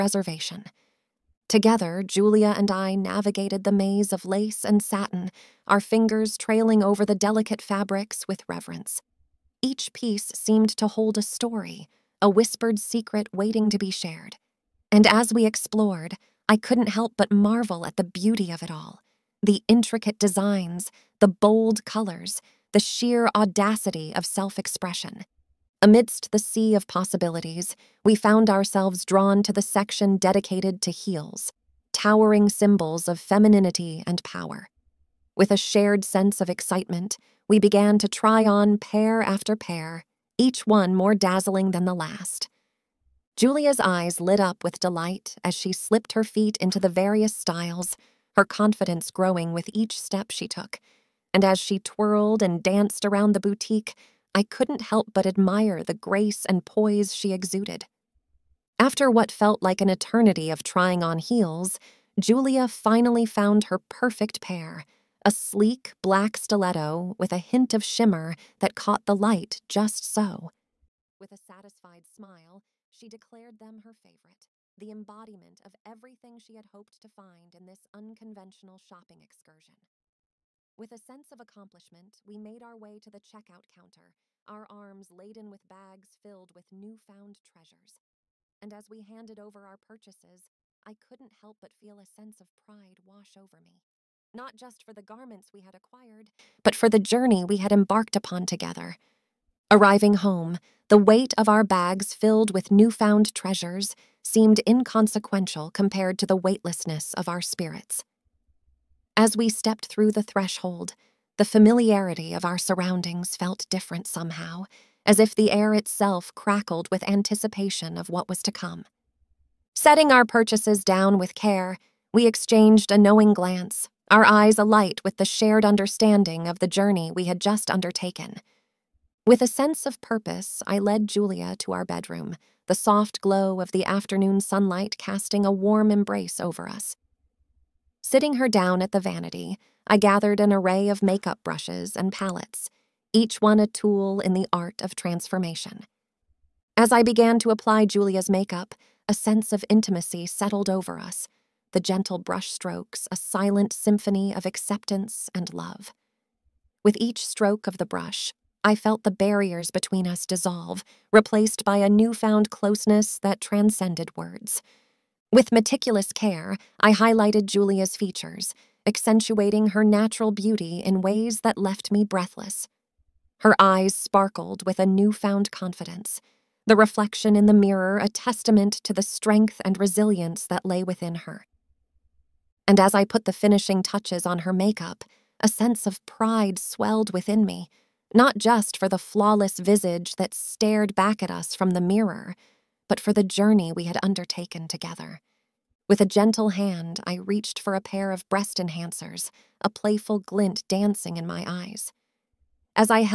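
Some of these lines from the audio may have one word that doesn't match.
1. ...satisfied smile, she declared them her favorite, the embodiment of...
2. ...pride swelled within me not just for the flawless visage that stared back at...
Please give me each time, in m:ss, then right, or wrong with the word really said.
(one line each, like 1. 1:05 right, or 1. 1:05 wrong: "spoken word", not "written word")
1. 1:11 right
2. 3:06 right.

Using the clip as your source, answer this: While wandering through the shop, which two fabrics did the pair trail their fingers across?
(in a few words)
lace and satin.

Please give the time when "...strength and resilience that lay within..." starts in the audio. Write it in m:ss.
2:59.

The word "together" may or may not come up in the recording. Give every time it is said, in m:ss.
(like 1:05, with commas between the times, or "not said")
0:01, 1:38, 3:14.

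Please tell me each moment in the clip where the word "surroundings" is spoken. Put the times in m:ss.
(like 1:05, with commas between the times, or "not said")
1:52.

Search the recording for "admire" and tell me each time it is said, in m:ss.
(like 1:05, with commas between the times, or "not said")
0:55.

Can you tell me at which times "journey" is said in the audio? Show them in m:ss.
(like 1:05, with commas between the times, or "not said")
1:36, 2:06, 3:13.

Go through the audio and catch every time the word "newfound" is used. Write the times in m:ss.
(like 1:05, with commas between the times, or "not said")
1:26, 1:42, 2:41, 2:54.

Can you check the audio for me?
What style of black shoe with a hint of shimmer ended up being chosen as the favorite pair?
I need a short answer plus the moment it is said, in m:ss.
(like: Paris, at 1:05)
stiletto, at 1:06.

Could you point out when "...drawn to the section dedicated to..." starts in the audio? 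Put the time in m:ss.
0:29.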